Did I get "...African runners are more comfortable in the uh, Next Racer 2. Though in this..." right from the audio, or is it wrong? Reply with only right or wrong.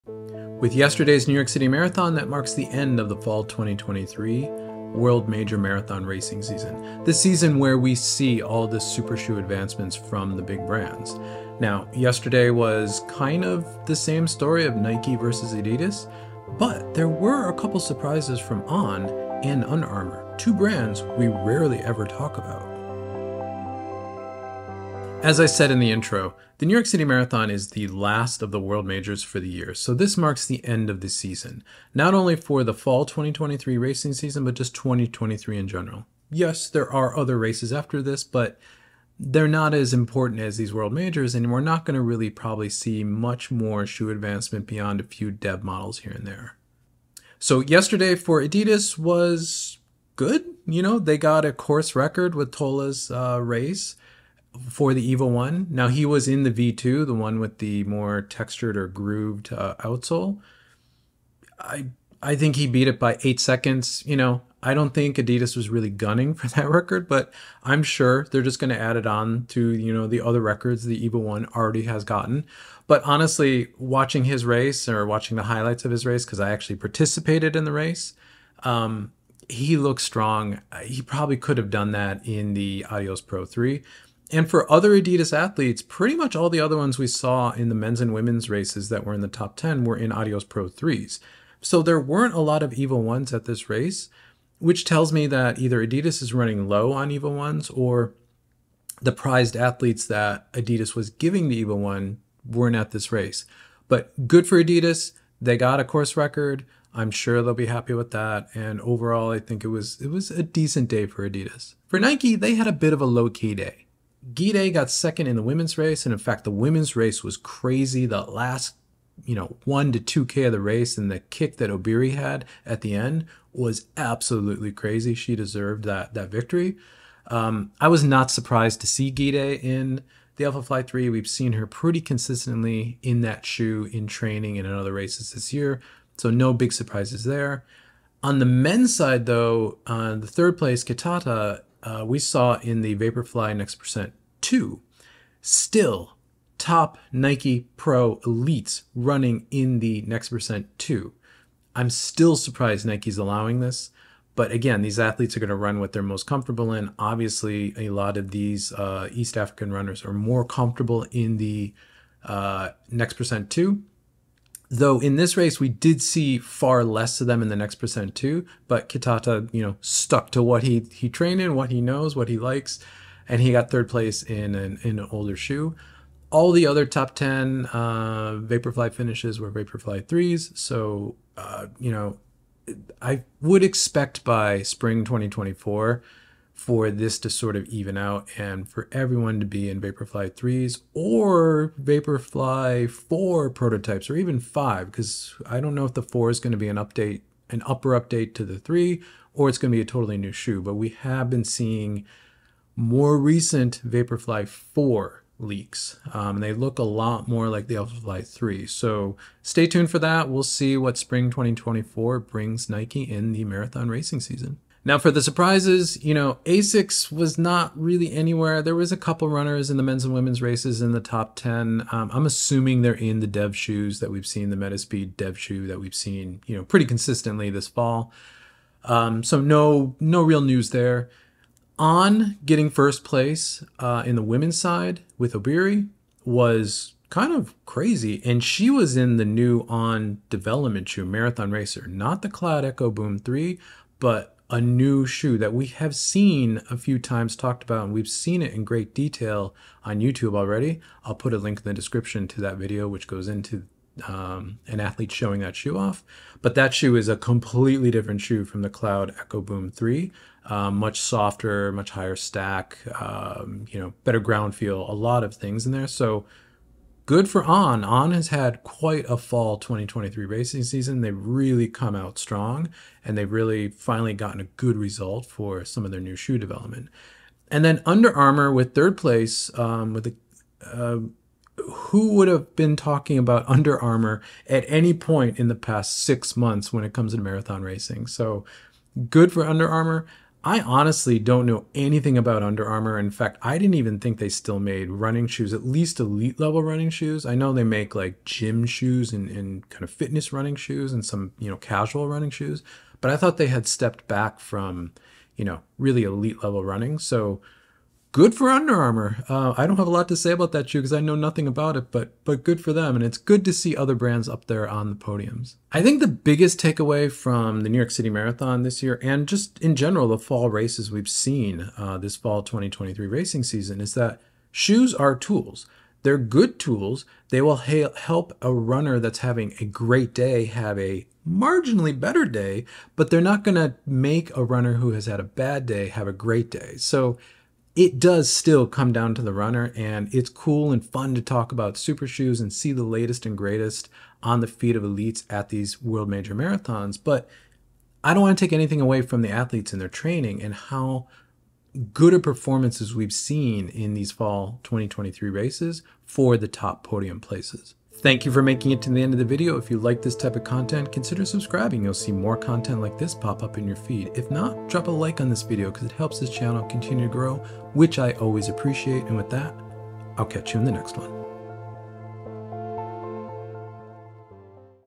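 wrong.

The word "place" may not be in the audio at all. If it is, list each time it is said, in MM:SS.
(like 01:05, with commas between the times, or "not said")
02:20, 02:53, 03:53, 04:38, 05:57.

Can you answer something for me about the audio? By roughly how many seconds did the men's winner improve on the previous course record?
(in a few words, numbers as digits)
8 seconds.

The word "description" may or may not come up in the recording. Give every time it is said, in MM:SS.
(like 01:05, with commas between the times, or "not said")
04:11.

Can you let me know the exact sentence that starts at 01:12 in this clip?
But honestly, watching his race or watching the highlights of his race because I actually participated in the race.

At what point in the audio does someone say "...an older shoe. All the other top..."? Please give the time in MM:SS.
02:54.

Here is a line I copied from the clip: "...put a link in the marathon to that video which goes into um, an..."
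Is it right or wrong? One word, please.
wrong.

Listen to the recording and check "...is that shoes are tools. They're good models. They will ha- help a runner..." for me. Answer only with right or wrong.
wrong.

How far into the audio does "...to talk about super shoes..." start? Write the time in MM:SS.
05:41.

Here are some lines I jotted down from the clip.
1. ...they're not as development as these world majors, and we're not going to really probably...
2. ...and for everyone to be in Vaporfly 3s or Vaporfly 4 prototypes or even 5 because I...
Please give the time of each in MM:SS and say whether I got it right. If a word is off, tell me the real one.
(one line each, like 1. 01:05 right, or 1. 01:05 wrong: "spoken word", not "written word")
1. 00:39 wrong: "important", not "development"
2. 03:08 right.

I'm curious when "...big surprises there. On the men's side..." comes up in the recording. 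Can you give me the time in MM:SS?
02:16.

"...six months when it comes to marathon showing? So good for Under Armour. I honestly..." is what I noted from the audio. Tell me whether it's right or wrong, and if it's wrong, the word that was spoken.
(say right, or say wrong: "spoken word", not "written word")
wrong: "racing", not "showing".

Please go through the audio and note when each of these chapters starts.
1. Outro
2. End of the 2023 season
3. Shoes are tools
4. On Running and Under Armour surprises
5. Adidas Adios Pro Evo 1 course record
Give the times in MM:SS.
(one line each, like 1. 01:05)
1. 05:58
2. 00:25
3. 05:16
4. 03:35
5. 00:47.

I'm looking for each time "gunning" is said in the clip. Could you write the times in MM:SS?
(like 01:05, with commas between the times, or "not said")
01:05.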